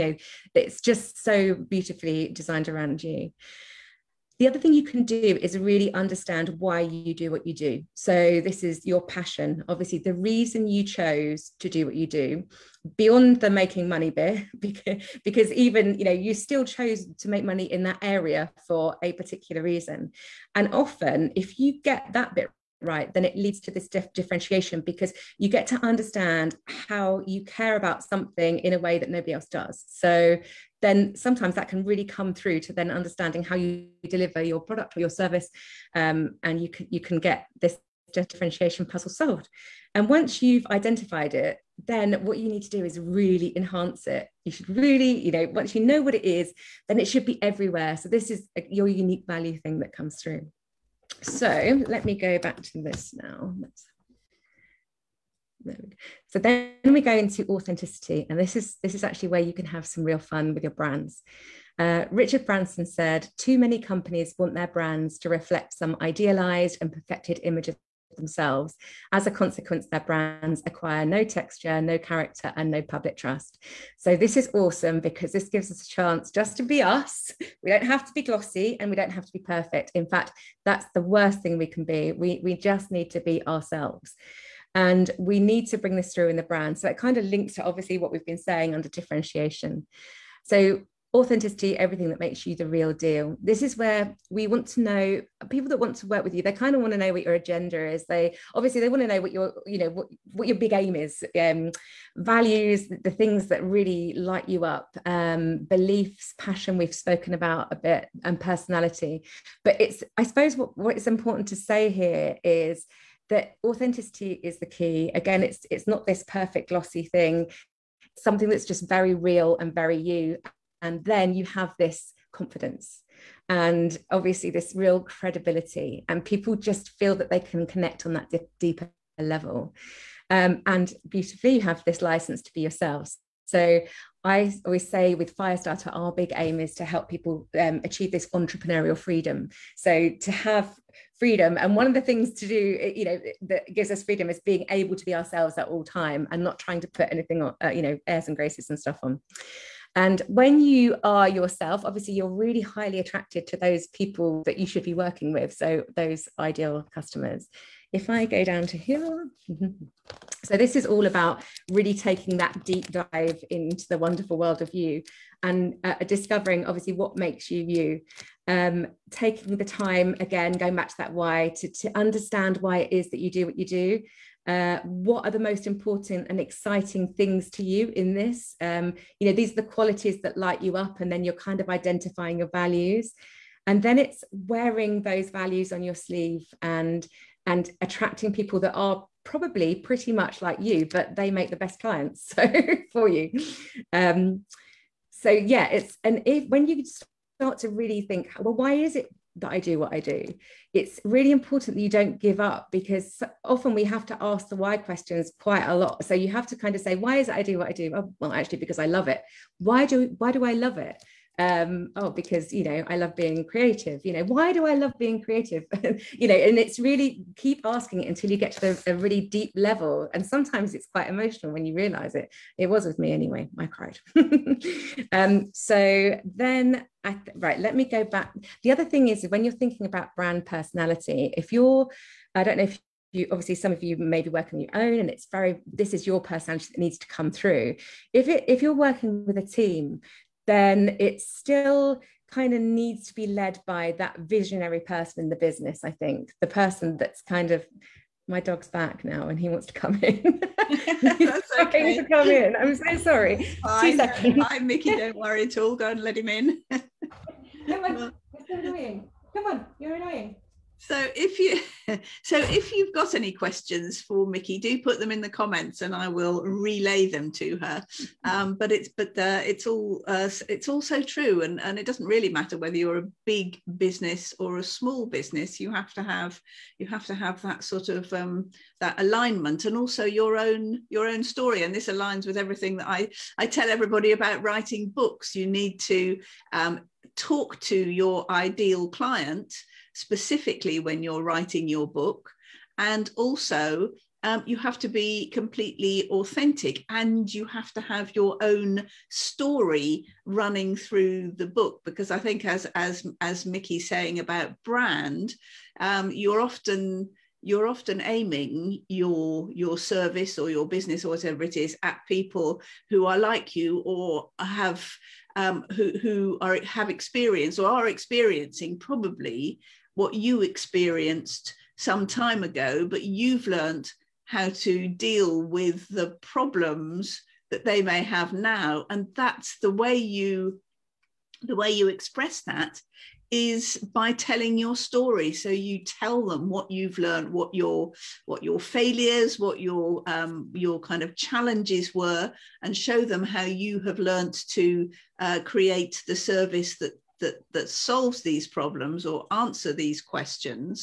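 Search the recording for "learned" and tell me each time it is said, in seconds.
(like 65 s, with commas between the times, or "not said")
323 s, 336 s, 343 s.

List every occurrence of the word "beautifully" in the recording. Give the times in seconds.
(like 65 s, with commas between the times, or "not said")
1 s, 131 s.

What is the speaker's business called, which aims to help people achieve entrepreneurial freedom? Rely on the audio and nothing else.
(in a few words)
Firestarter.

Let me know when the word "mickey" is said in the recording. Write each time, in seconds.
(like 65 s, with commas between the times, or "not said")
254 s, 264 s, 303 s.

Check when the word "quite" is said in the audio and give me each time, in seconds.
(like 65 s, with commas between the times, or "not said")
205 s, 220 s.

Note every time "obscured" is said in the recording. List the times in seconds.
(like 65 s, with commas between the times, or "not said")
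not said.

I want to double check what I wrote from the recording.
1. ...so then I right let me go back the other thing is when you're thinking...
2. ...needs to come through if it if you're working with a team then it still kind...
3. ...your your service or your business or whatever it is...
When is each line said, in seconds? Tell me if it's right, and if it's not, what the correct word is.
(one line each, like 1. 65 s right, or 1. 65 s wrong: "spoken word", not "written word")
1. 225 s right
2. 236 s right
3. 308 s right.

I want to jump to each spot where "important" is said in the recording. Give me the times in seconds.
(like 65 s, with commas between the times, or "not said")
111 s, 175 s, 201 s.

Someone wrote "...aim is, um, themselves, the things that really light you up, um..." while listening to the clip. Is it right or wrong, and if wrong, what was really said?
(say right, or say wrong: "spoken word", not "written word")
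wrong: "values", not "themselves".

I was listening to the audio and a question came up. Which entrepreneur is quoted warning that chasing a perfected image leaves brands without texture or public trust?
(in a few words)
Richard Branson.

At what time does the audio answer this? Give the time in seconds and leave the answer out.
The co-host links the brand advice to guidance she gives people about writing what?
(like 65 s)
284 s.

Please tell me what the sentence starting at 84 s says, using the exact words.
And we need to bring this through in the brand.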